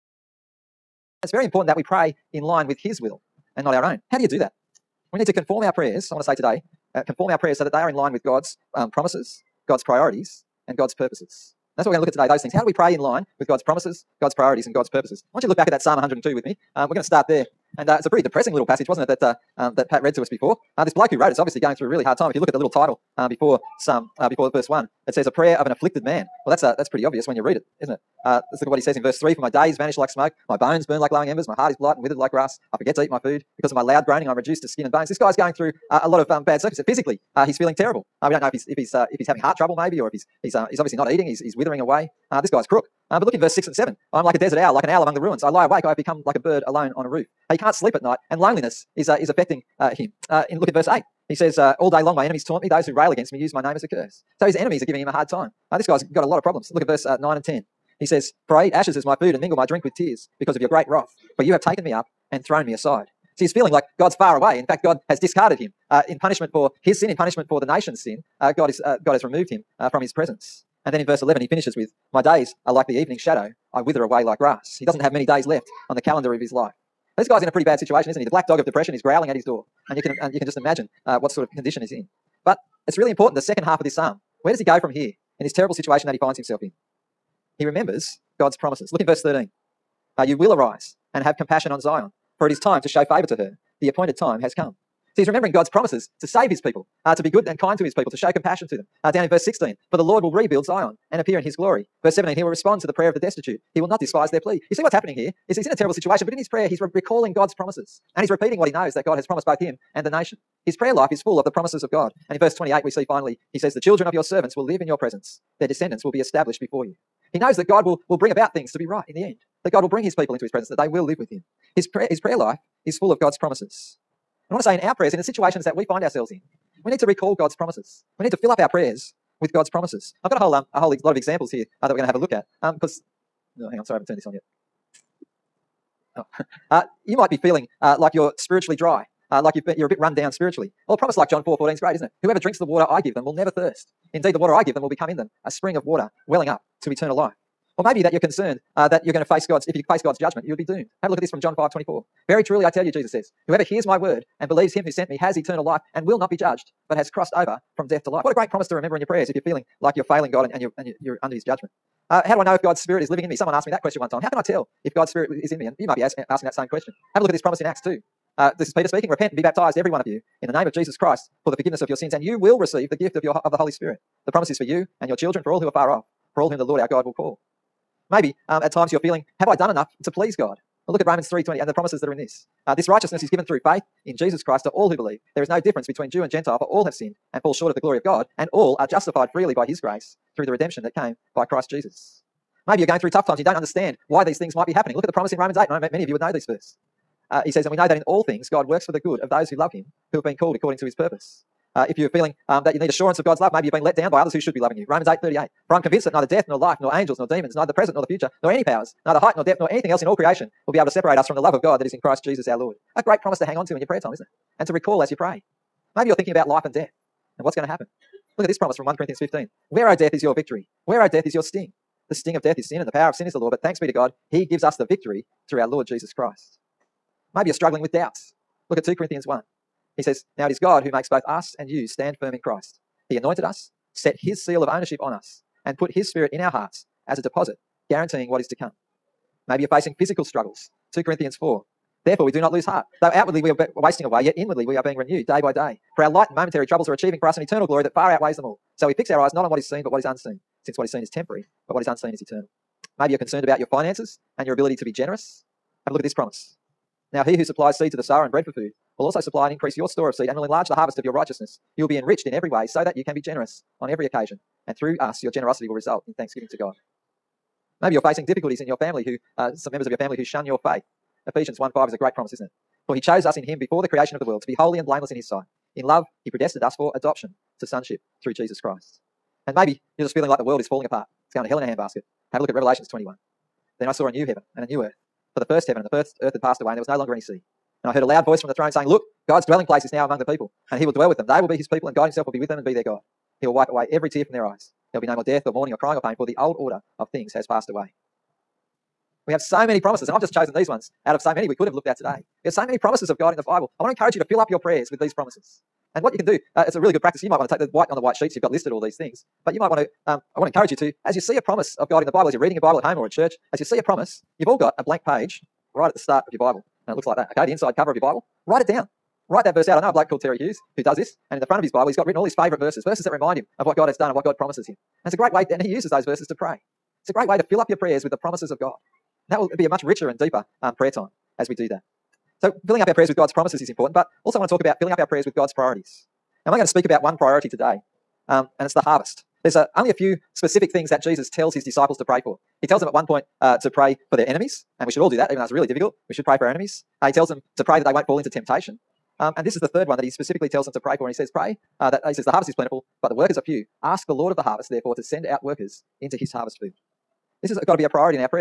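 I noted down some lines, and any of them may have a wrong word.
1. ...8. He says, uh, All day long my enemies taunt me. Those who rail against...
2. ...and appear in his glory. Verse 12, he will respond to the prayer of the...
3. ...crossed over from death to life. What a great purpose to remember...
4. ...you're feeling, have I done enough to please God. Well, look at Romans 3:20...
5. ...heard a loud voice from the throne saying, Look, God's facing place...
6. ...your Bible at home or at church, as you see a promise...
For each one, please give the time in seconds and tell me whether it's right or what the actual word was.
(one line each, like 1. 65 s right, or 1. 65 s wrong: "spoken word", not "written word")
1. 50 s right
2. 101 s wrong: "17", not "12"
3. 157 s wrong: "promise", not "purpose"
4. 178 s right
5. 287 s wrong: "dwelling", not "facing"
6. 312 s right.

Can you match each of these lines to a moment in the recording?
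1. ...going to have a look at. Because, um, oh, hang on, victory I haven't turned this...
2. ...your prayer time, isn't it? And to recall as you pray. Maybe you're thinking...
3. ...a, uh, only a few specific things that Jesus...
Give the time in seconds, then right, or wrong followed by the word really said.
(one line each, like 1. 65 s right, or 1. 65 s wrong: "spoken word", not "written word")
1. 131 s wrong: "sorry", not "victory"
2. 213 s right
3. 339 s right.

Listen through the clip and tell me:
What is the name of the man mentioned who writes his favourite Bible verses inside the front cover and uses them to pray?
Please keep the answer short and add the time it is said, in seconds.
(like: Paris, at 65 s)
Terry Hughes, at 320 s.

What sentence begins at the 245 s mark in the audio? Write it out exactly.
For our light and momentary troubles are achieving for us an eternal glory that far outweighs them all.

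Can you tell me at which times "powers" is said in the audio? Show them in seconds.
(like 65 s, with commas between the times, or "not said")
208 s, 222 s.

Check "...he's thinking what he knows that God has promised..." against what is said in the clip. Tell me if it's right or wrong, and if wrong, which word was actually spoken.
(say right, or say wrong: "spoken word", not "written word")
wrong: "repeating", not "thinking".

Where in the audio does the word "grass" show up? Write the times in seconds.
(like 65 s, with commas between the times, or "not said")
32 s, 74 s.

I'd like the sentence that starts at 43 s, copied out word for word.
but look in verse six and seven.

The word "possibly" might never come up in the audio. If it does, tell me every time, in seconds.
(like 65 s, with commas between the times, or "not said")
not said.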